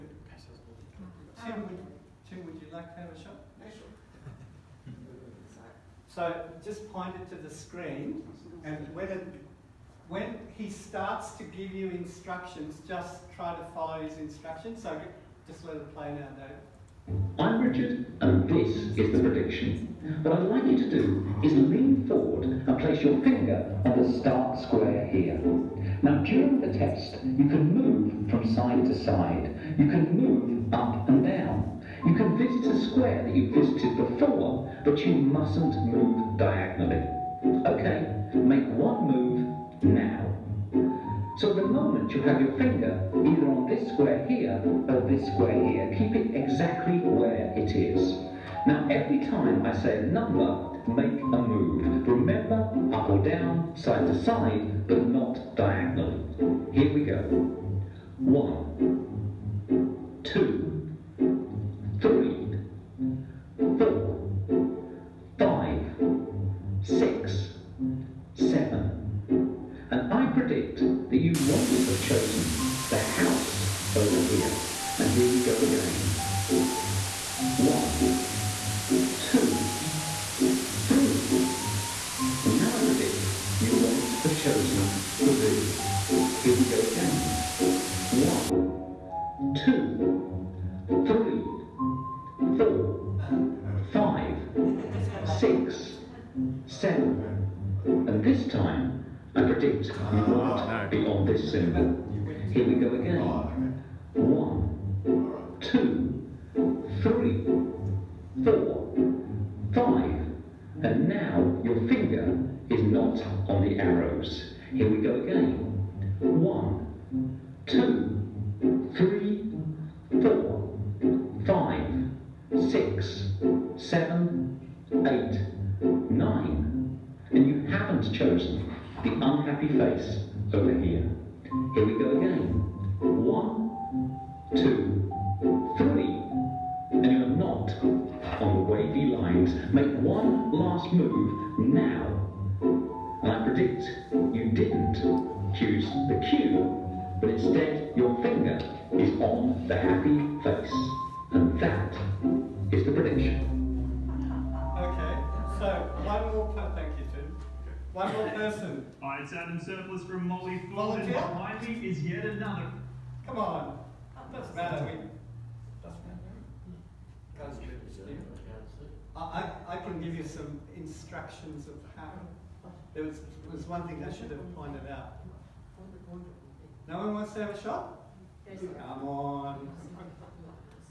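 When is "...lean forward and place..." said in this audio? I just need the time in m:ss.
0:21.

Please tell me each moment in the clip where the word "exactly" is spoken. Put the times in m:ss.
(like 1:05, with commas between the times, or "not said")
0:46.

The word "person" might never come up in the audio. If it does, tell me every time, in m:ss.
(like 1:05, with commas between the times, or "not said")
2:38.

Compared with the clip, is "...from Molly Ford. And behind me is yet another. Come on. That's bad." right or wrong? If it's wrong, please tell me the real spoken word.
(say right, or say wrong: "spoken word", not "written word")
right.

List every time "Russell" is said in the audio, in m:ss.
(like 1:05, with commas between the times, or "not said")
not said.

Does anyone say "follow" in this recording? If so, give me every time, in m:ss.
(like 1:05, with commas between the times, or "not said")
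0:13.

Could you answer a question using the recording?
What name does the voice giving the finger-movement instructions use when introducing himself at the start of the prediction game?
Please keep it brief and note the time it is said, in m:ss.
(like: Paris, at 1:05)
Richard, at 0:17.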